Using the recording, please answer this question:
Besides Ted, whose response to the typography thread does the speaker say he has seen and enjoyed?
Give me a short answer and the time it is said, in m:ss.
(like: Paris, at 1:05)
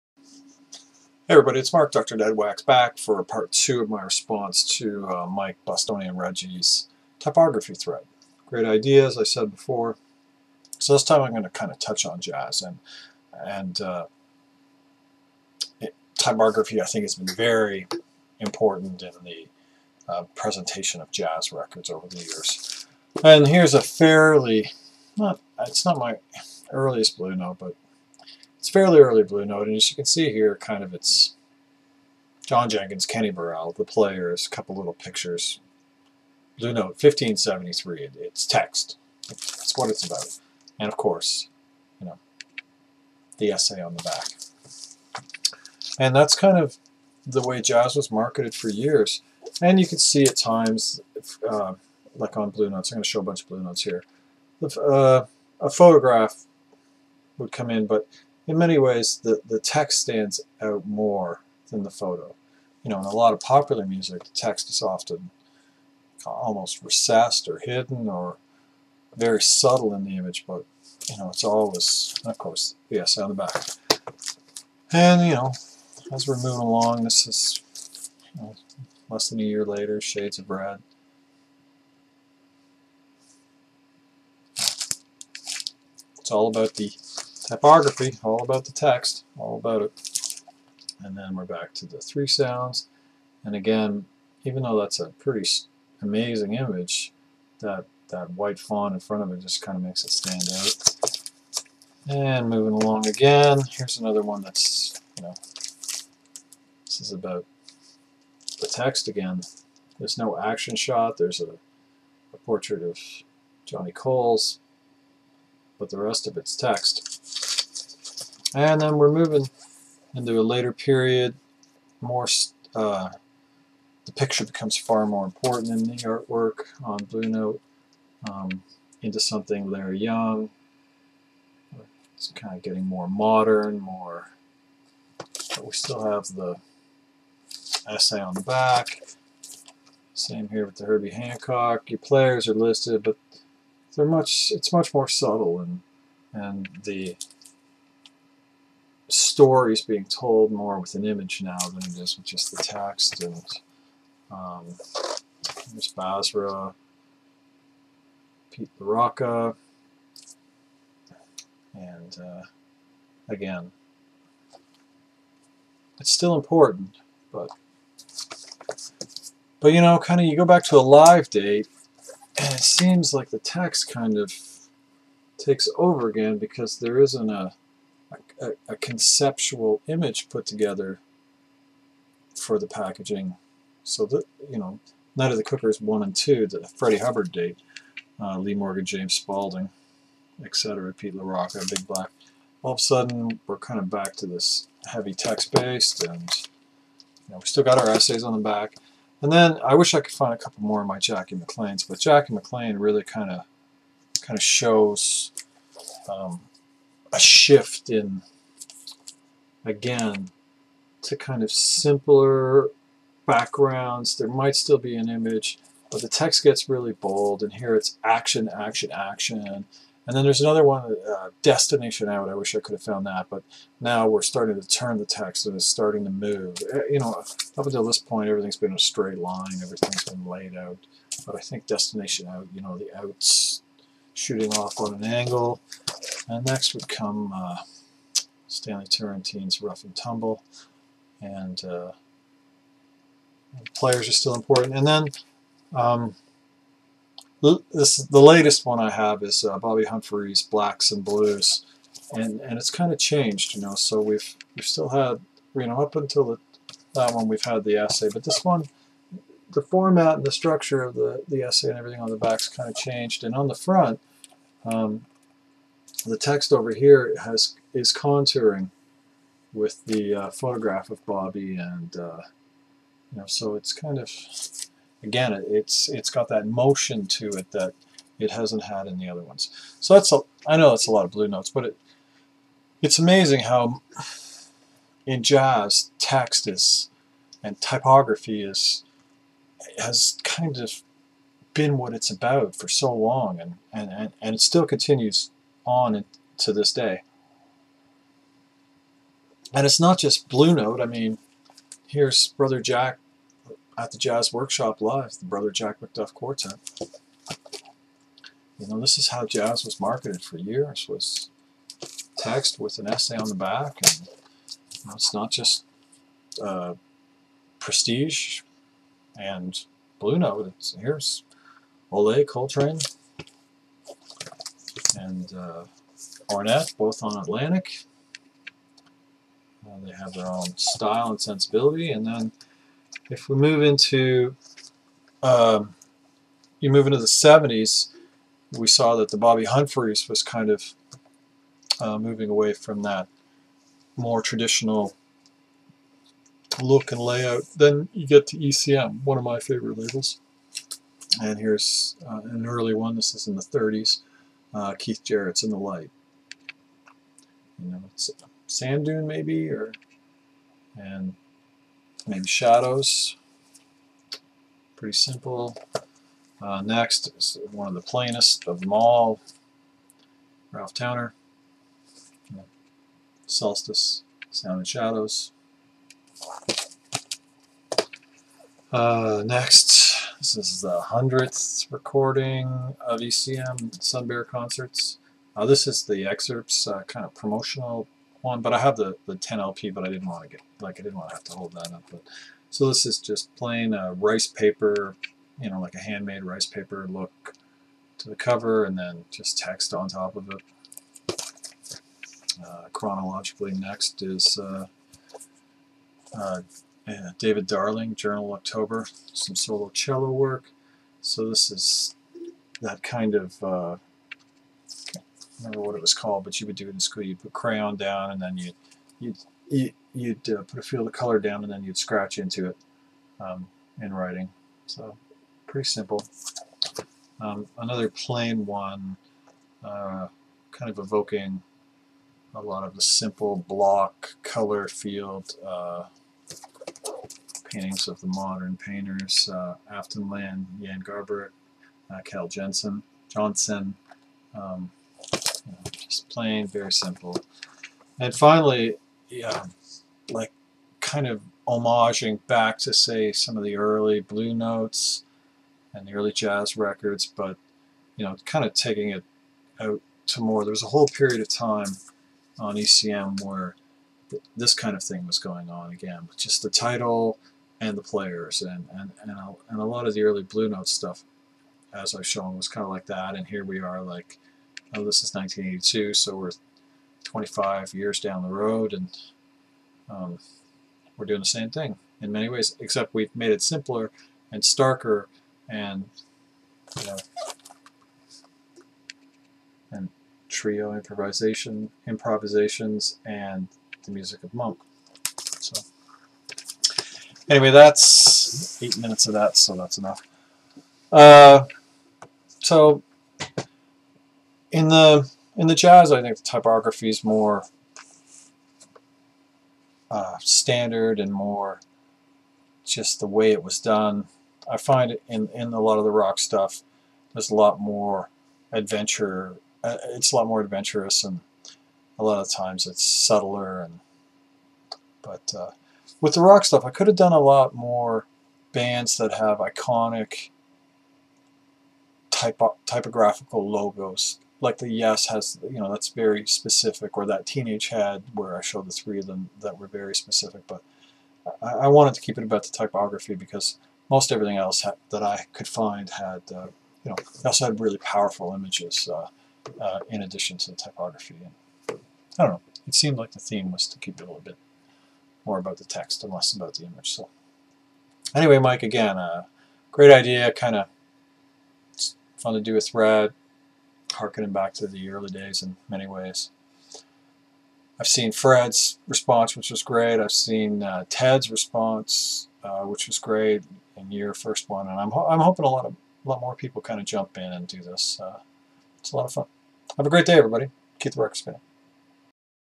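Fred, at 9:28.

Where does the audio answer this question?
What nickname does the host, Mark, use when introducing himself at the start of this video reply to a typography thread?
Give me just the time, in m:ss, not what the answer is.
0:01.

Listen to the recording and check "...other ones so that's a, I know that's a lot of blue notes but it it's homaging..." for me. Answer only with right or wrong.
wrong.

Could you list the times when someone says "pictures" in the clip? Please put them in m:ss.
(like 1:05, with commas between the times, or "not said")
0:34, 2:04.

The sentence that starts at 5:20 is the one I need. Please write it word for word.
It's, here's Olé Coltrane and uh, both on Atlantic they have their own style and sensibility.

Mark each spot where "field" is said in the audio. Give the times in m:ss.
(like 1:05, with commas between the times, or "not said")
7:00, 7:14.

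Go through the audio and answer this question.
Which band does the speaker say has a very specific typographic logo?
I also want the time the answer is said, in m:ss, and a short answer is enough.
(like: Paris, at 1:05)
Teenage Head, at 8:57.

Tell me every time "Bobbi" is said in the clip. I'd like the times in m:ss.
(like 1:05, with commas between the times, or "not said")
4:09, 4:31, 5:39.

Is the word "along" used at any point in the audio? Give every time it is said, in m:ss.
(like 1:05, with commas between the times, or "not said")
1:16, 1:42.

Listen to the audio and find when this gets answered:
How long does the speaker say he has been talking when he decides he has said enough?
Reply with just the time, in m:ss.
8:18.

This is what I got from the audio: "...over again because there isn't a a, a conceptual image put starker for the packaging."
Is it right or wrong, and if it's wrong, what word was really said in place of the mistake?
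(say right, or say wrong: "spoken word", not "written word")
wrong: "together", not "starker".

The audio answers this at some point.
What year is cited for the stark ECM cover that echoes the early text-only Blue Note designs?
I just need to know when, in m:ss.
7:55.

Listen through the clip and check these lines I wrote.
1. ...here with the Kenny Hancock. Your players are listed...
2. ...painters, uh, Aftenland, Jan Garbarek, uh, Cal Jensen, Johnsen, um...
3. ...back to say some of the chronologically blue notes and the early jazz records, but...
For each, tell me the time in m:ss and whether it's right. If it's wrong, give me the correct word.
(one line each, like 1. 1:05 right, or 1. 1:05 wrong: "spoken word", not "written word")
1. 2:20 wrong: "Herbie", not "Kenny"
2. 7:18 right
3. 7:32 wrong: "early", not "chronologically".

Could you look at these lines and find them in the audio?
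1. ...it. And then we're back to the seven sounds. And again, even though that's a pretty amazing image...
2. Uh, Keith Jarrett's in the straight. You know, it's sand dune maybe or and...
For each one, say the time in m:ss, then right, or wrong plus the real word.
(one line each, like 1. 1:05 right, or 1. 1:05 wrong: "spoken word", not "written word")
1. 1:29 wrong: "three", not "seven"
2. 5:54 wrong: "light", not "straight".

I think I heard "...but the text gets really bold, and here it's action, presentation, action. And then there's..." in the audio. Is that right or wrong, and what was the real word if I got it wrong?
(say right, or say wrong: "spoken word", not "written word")
wrong: "action", not "presentation".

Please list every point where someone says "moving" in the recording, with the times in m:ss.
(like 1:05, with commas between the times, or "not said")
1:16, 1:42, 1:59, 5:41.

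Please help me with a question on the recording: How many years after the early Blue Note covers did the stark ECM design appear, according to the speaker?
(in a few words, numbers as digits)
25.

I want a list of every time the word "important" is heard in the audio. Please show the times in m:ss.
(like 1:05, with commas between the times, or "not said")
0:18, 2:05, 2:46, 4:04.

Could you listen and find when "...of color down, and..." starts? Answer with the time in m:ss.
7:00.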